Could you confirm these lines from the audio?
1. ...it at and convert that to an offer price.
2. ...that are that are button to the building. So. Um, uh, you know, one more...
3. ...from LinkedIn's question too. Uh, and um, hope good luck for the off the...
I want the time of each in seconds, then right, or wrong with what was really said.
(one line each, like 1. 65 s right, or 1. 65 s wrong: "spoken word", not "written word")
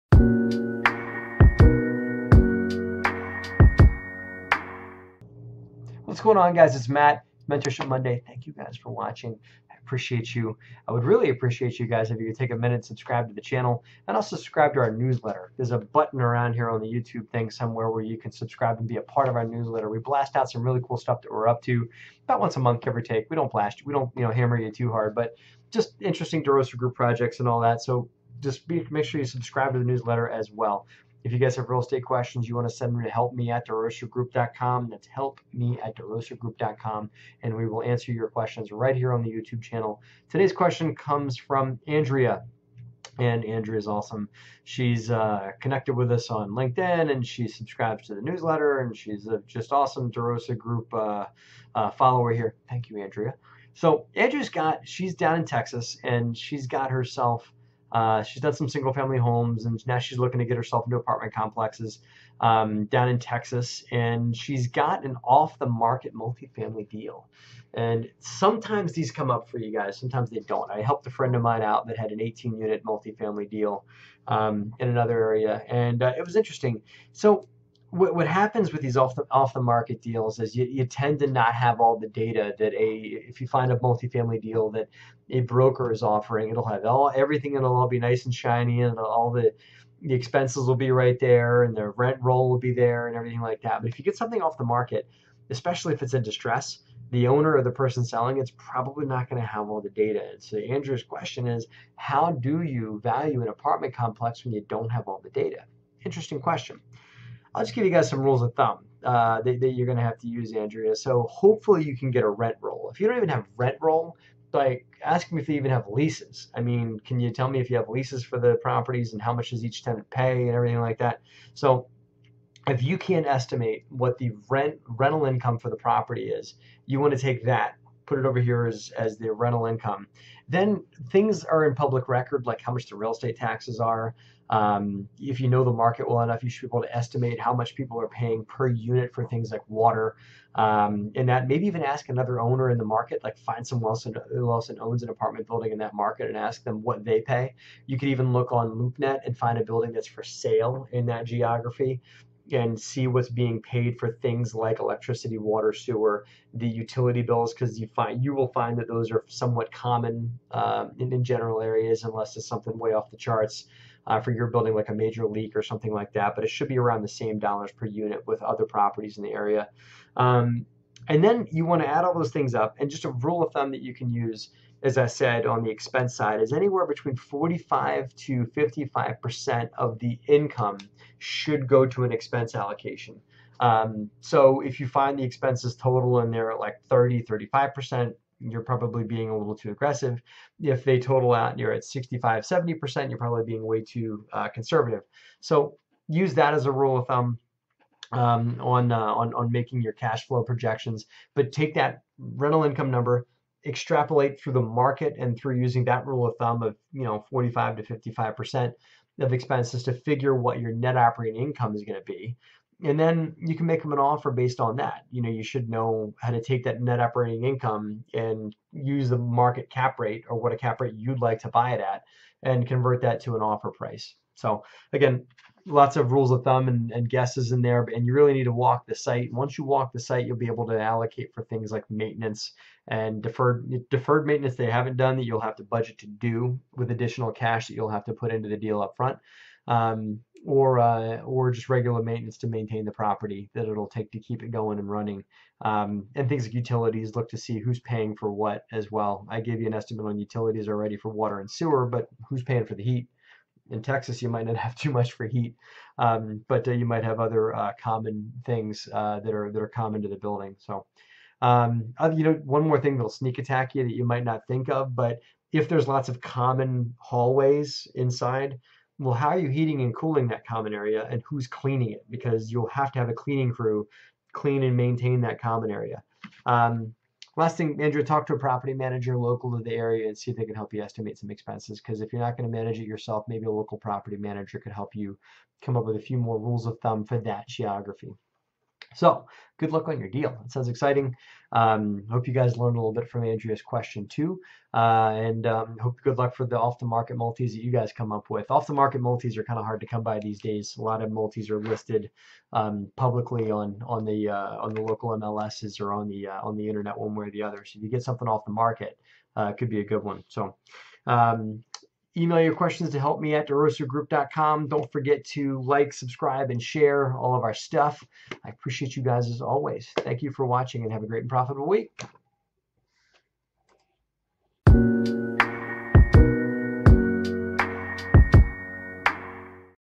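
1. 221 s right
2. 259 s wrong: "common", not "button"
3. 293 s wrong: "Andrea", not "LinkedIn".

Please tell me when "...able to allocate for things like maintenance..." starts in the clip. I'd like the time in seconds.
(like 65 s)
230 s.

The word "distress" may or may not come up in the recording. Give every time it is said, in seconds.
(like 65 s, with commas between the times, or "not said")
96 s.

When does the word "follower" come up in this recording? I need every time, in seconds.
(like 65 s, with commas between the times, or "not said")
51 s.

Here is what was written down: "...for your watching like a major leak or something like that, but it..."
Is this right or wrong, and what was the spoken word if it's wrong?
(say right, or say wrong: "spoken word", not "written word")
wrong: "building", not "watching".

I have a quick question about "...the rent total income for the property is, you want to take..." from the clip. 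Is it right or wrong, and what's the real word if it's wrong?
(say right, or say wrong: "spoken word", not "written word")
wrong: "rental", not "total".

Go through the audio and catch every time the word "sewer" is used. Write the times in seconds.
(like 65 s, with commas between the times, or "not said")
155 s, 251 s.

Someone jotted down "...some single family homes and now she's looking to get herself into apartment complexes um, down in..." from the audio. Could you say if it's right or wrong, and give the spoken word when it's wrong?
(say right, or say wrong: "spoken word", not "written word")
right.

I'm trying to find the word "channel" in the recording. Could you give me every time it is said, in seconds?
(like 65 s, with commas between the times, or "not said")
13 s, 39 s.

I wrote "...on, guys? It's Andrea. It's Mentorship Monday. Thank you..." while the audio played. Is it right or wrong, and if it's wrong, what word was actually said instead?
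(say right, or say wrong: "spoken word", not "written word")
wrong: "Matt", not "Andrea".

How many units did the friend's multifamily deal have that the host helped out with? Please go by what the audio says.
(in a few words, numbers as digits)
18.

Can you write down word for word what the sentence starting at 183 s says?
Um, so if you find the expenses total in there at like 30, 35%, you're probably being a little too aggressive.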